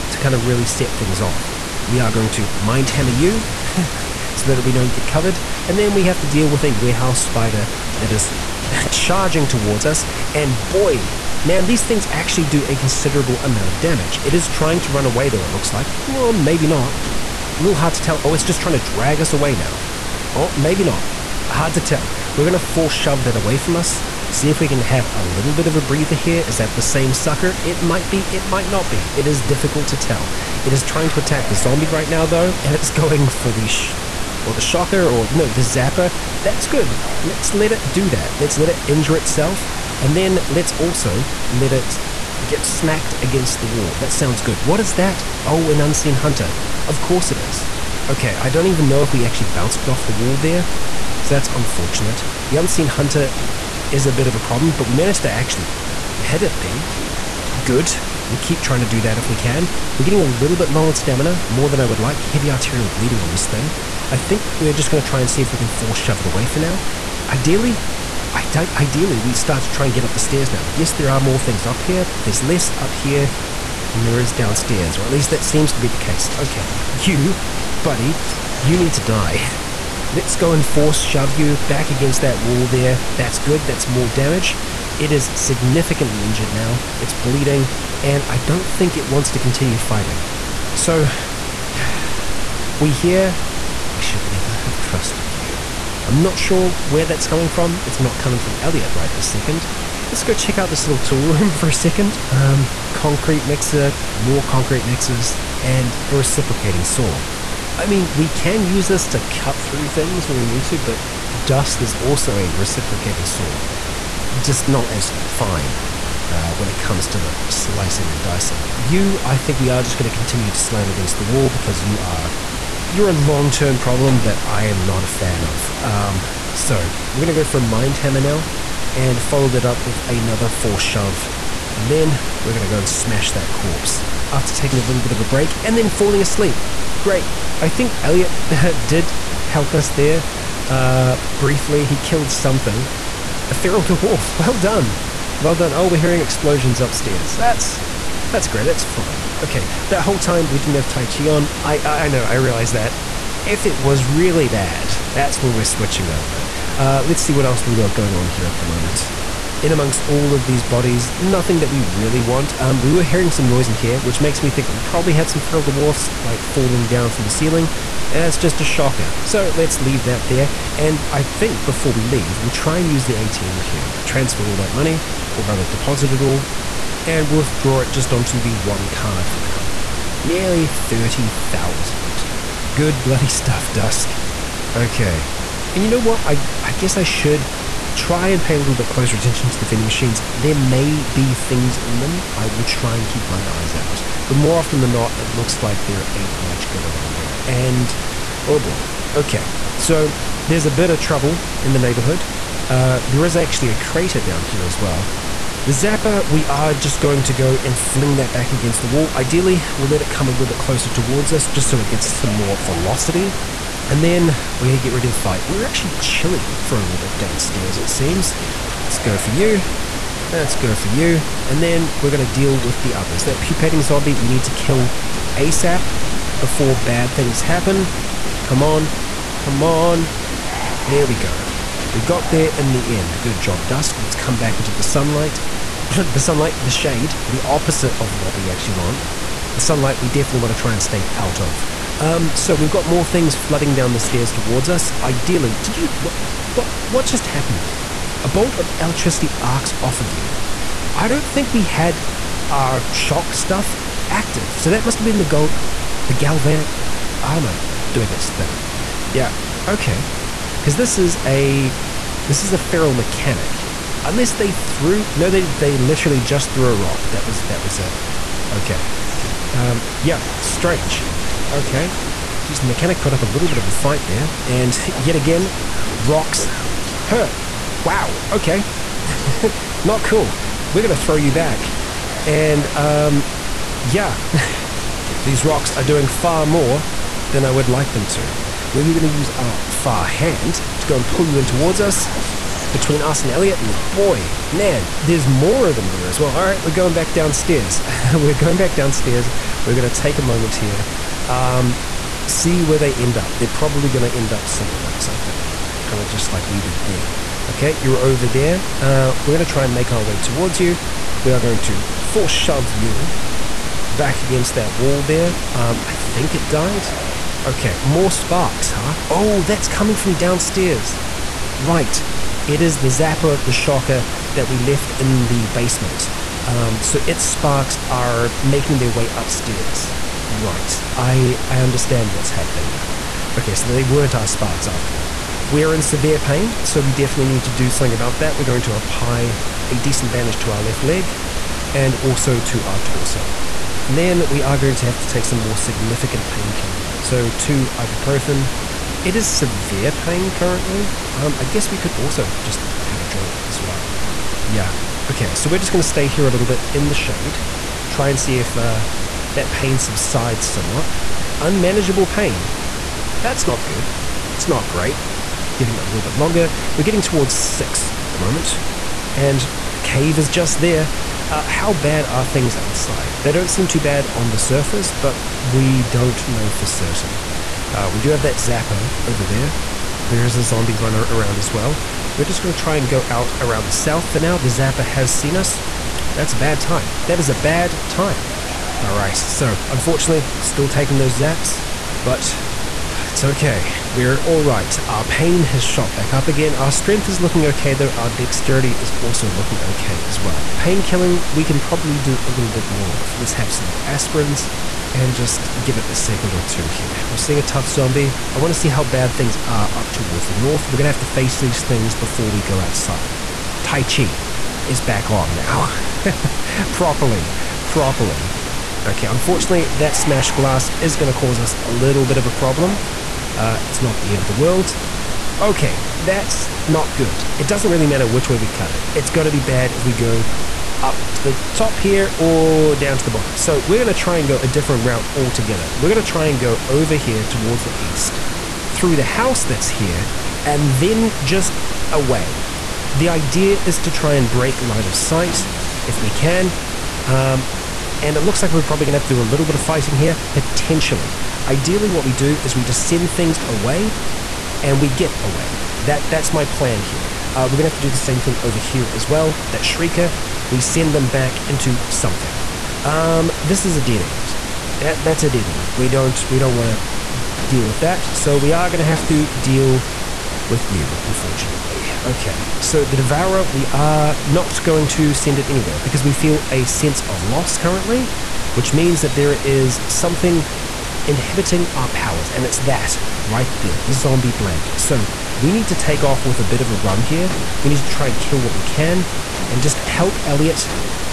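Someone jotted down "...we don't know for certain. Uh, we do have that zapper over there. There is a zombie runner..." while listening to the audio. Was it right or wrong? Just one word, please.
right.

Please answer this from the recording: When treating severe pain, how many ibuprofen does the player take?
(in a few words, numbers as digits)
2.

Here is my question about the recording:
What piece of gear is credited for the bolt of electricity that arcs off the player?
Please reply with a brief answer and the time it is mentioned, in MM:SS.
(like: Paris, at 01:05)
Galvanic armor, at 04:16.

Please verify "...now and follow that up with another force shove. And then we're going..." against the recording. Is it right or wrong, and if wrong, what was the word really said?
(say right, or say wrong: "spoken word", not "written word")
right.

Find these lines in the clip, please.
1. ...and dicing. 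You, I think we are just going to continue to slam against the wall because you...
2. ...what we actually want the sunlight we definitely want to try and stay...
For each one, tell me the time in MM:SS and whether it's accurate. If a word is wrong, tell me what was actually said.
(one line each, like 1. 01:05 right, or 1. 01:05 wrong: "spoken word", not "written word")
1. 01:58 right
2. 03:58 right.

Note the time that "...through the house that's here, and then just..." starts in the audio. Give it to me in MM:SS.
07:18.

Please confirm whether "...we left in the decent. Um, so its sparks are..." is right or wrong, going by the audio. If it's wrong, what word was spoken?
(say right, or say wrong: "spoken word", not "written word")
wrong: "basement", not "decent".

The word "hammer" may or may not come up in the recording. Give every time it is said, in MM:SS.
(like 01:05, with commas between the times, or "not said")
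00:02, 02:07.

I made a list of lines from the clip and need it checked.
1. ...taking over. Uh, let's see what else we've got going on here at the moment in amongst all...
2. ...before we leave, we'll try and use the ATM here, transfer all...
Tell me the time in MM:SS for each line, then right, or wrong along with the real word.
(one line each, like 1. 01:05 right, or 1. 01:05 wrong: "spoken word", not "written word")
1. 02:35 wrong: "switching", not "taking"
2. 02:51 right.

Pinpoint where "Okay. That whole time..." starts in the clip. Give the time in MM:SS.
02:29.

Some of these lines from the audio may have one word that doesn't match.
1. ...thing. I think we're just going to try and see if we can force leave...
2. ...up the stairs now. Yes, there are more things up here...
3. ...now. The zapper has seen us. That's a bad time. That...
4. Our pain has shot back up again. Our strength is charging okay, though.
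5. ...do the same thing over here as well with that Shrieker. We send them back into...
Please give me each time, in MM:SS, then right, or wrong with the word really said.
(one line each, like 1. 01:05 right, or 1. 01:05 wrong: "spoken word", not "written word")
1. 01:03 wrong: "shove", not "leave"
2. 01:10 right
3. 06:24 right
4. 06:34 wrong: "looking", not "charging"
5. 07:37 right.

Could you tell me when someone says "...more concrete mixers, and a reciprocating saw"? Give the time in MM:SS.
01:44.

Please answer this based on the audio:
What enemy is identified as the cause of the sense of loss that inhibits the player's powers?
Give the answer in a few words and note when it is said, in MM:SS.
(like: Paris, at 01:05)
Zombie blank, at 08:03.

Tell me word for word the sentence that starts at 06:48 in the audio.
I want to see how bad things are up towards the north.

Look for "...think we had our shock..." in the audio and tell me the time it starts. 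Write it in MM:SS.
04:11.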